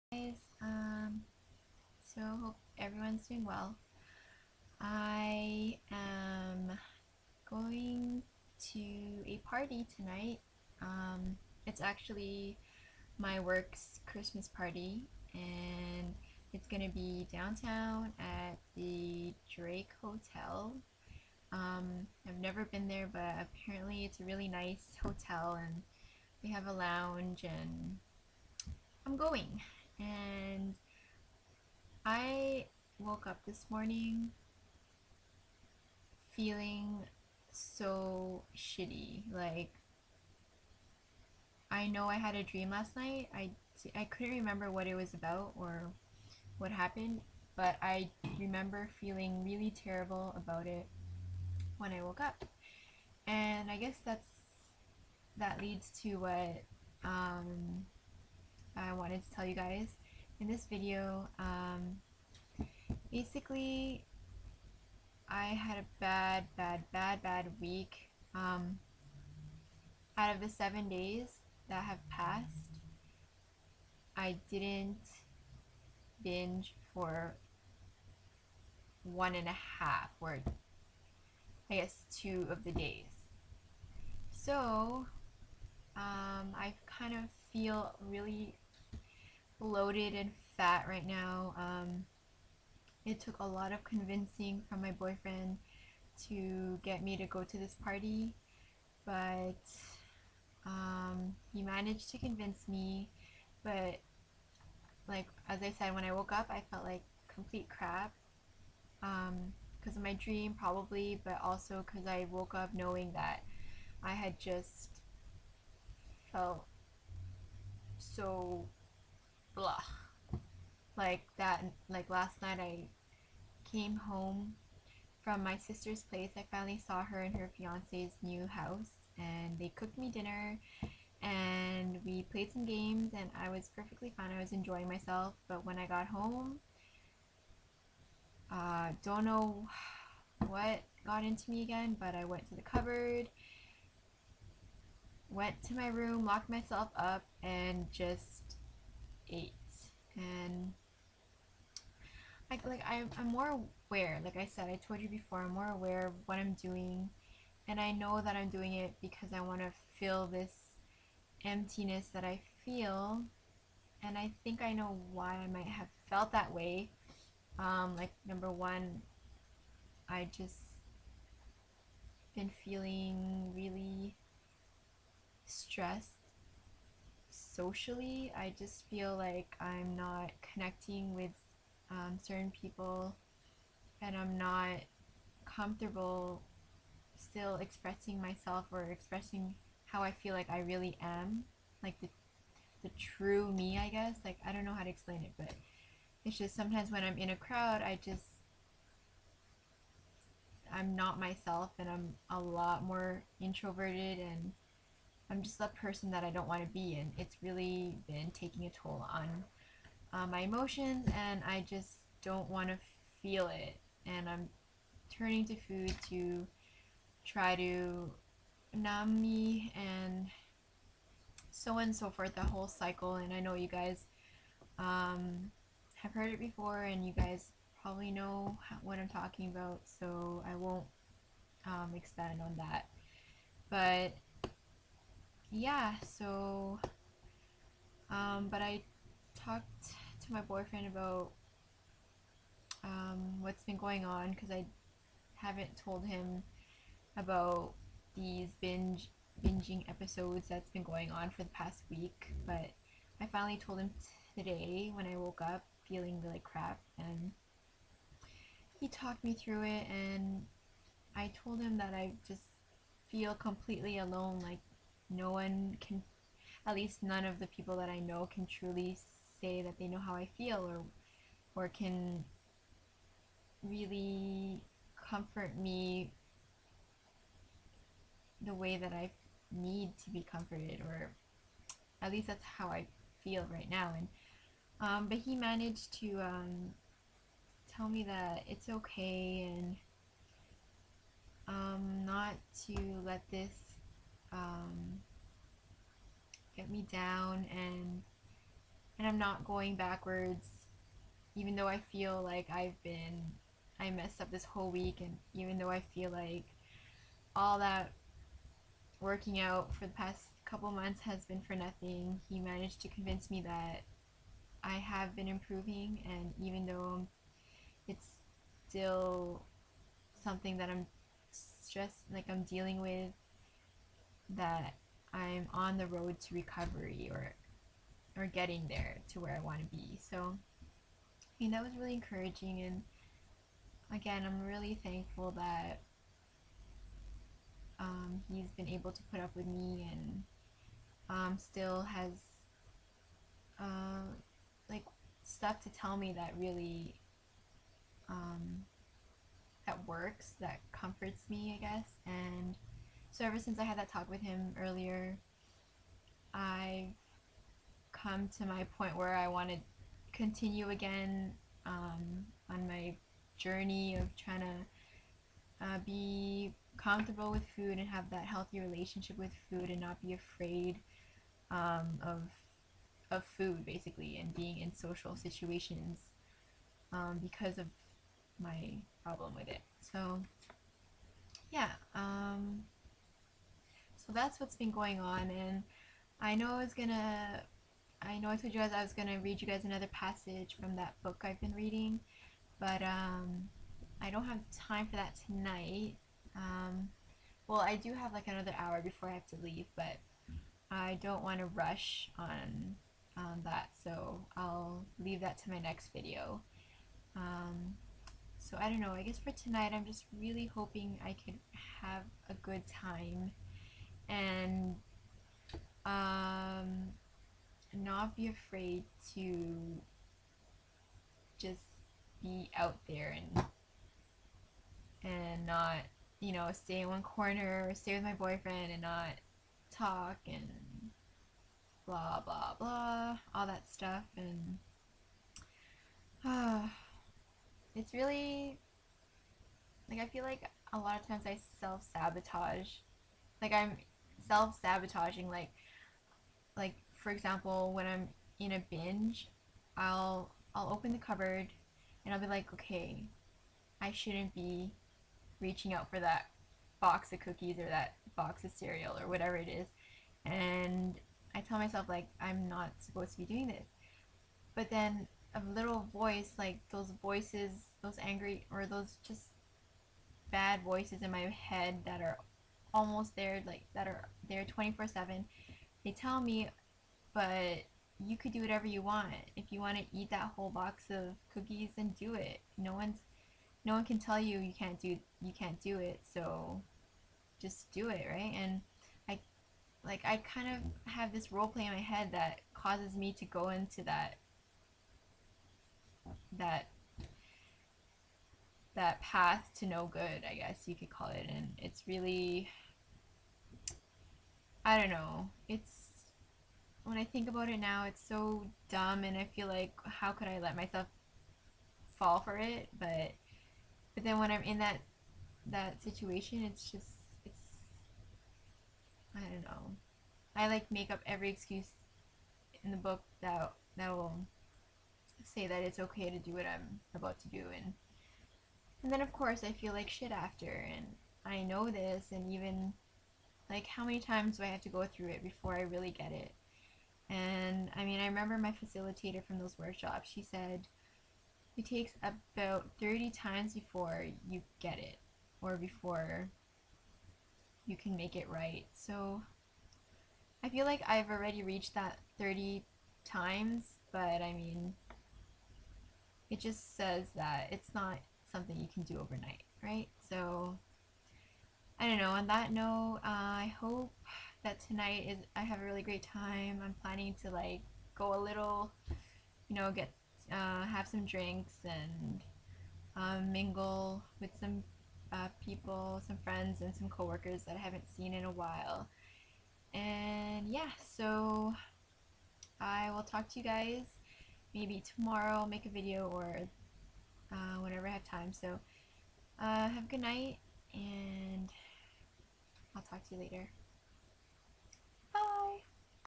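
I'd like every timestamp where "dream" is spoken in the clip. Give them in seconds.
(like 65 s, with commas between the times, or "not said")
42 s, 110 s.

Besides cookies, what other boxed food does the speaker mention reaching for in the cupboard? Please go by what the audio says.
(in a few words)
cereal.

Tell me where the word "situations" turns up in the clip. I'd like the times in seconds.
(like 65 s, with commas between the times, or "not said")
375 s, 515 s.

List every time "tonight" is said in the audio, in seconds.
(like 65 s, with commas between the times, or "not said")
9 s, 395 s, 409 s, 564 s.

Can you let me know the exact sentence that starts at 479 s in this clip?
If you want to eat that whole box of cookies, then do it.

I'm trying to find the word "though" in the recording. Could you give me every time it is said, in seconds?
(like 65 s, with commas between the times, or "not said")
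301 s, 305 s, 316 s.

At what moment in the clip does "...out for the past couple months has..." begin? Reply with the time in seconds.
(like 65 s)
309 s.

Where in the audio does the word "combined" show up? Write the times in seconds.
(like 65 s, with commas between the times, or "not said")
not said.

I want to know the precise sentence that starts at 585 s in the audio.
I'll make a video or uh, whenever I have time.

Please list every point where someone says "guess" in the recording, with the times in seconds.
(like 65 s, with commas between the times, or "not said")
53 s, 81 s, 193 s, 351 s, 409 s, 500 s.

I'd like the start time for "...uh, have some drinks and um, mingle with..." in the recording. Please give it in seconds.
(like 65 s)
570 s.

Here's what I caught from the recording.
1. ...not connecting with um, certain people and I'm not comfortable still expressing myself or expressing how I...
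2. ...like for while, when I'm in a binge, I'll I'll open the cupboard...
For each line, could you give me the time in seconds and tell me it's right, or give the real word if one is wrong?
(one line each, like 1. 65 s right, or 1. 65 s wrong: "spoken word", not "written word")
1. 179 s right
2. 446 s wrong: "example", not "while".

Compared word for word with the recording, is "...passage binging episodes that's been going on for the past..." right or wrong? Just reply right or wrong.
wrong.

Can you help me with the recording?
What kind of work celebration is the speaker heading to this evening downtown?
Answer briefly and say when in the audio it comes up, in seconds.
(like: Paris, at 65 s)
Christmas party, at 14 s.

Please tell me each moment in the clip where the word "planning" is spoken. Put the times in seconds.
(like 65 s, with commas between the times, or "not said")
566 s.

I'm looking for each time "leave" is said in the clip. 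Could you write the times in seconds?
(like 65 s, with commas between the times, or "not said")
399 s, 404 s.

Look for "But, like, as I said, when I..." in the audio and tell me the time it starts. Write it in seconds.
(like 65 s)
103 s.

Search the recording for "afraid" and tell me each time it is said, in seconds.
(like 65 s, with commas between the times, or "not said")
370 s, 418 s.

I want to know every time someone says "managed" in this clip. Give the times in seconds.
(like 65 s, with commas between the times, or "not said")
101 s, 285 s, 312 s.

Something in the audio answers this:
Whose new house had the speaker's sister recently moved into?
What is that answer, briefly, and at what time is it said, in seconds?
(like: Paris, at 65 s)
her fiance's, at 127 s.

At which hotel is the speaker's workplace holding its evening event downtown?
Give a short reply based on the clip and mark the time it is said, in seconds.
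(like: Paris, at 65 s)
Drake Hotel, at 19 s.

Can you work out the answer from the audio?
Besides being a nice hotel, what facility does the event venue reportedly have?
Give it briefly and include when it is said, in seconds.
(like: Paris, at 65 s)
a lounge, at 26 s.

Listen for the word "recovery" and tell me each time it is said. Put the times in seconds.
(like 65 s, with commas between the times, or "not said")
326 s.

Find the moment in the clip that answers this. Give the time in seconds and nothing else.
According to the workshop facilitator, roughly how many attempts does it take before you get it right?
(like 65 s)
542 s.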